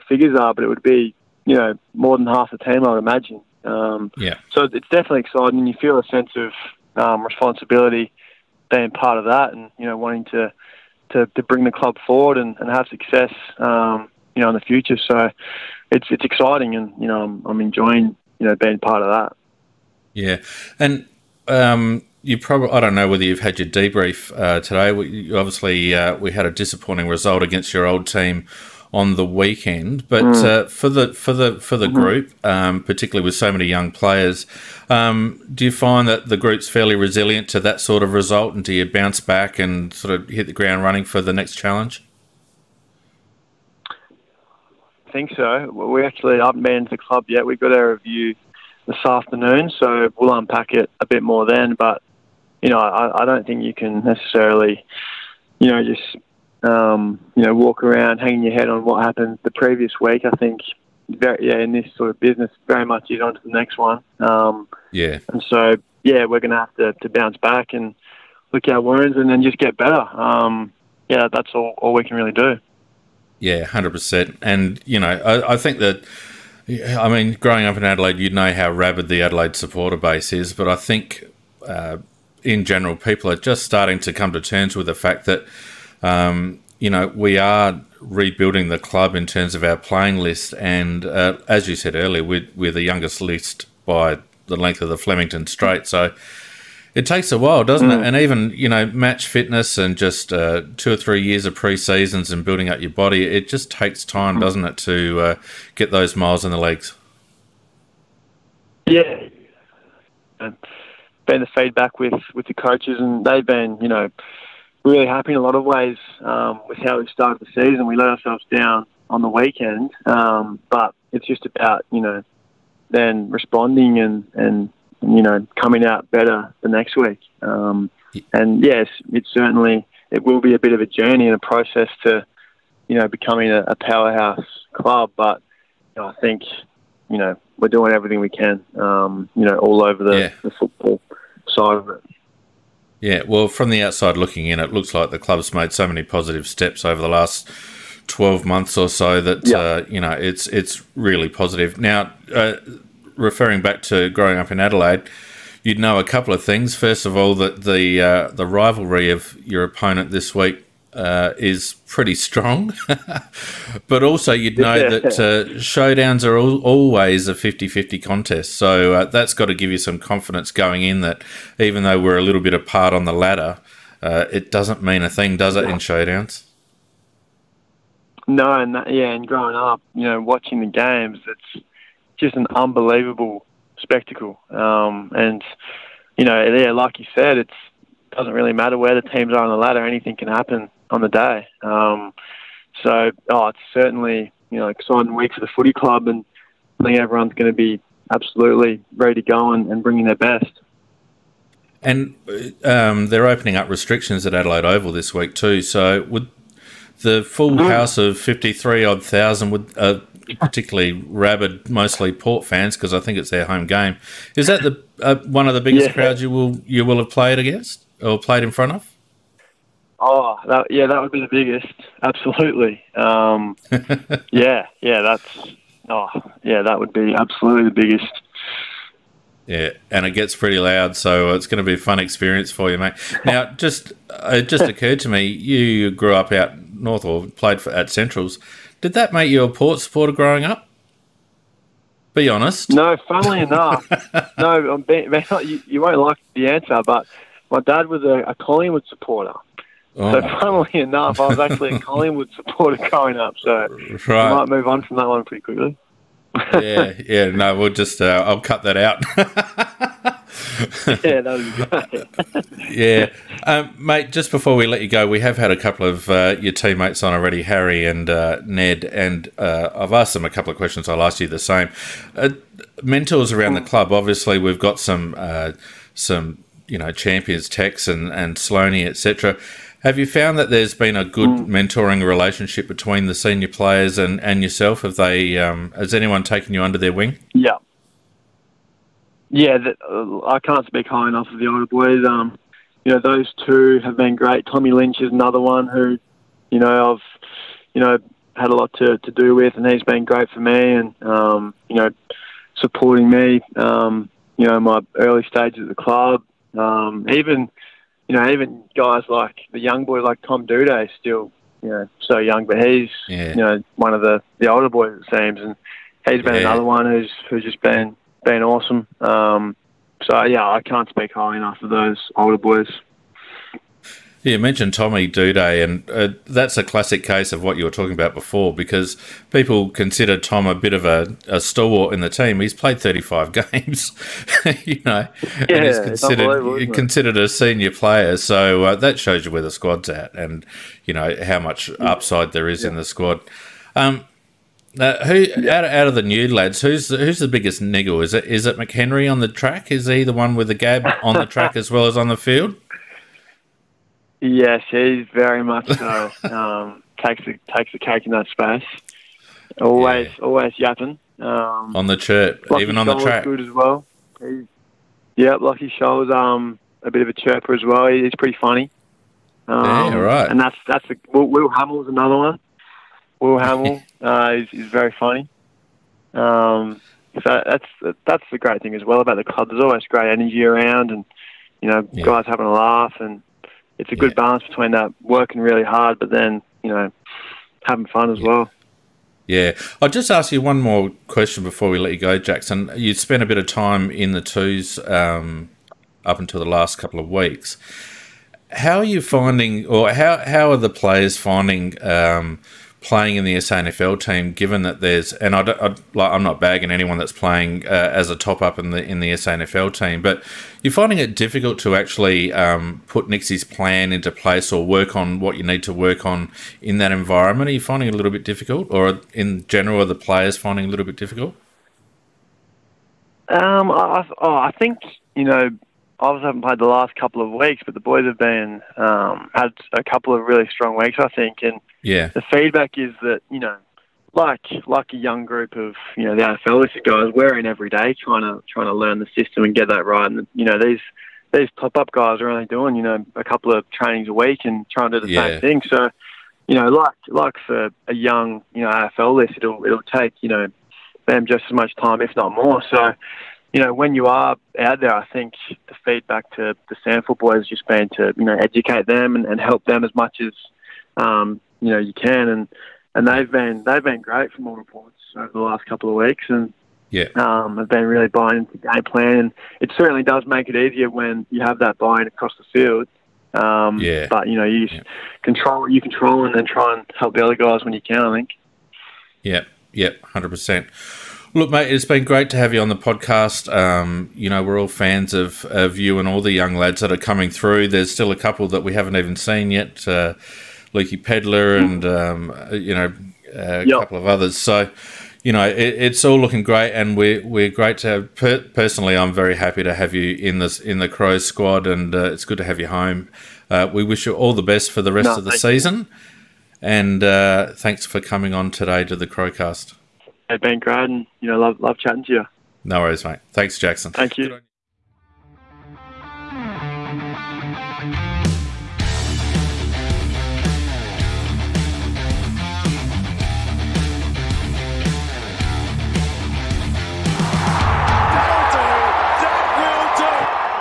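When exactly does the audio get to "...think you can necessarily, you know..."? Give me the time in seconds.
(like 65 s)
53 s.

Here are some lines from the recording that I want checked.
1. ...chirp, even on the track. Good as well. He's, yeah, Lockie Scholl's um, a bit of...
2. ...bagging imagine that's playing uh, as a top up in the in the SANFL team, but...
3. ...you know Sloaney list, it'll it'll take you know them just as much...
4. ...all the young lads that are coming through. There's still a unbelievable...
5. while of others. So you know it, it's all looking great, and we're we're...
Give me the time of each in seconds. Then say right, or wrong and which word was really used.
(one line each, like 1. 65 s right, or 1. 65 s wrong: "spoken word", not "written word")
1. 361 s right
2. 406 s wrong: "anyone", not "imagine"
3. 448 s wrong: "AFL", not "Sloaney"
4. 486 s wrong: "couple", not "unbelievable"
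5. 493 s wrong: "couple", not "while".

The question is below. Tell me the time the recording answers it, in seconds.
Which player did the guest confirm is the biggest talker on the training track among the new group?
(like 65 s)
348 s.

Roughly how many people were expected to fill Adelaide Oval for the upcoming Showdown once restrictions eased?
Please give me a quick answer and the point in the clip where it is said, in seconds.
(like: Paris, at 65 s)
53,000, at 208 s.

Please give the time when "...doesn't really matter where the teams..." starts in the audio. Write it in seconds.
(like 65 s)
188 s.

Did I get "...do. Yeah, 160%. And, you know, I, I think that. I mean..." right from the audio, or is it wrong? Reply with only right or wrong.
wrong.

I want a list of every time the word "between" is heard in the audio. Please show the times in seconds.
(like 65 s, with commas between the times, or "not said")
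282 s, 384 s.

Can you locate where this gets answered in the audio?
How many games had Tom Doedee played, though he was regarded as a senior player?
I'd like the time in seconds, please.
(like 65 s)
332 s.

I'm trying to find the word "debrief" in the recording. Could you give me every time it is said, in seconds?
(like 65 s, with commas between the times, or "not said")
23 s.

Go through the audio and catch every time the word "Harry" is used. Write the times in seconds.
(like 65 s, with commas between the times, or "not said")
267 s.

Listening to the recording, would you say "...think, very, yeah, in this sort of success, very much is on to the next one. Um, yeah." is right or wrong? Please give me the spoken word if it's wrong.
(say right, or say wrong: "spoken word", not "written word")
wrong: "business", not "success".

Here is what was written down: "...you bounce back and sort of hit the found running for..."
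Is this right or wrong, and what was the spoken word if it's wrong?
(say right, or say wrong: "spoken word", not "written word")
wrong: "ground", not "found".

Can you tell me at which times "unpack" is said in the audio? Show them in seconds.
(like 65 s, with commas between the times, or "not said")
50 s.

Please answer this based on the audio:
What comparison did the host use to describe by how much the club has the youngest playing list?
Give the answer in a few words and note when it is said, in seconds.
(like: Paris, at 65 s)
The length of the Flemington straight, at 94 s.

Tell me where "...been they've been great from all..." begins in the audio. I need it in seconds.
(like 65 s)
463 s.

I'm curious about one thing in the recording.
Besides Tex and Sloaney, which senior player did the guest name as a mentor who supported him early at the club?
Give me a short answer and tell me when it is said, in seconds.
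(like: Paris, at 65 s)
Tommy Lynch, at 294 s.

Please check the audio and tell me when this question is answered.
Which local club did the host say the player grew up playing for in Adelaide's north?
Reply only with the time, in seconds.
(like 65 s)
237 s.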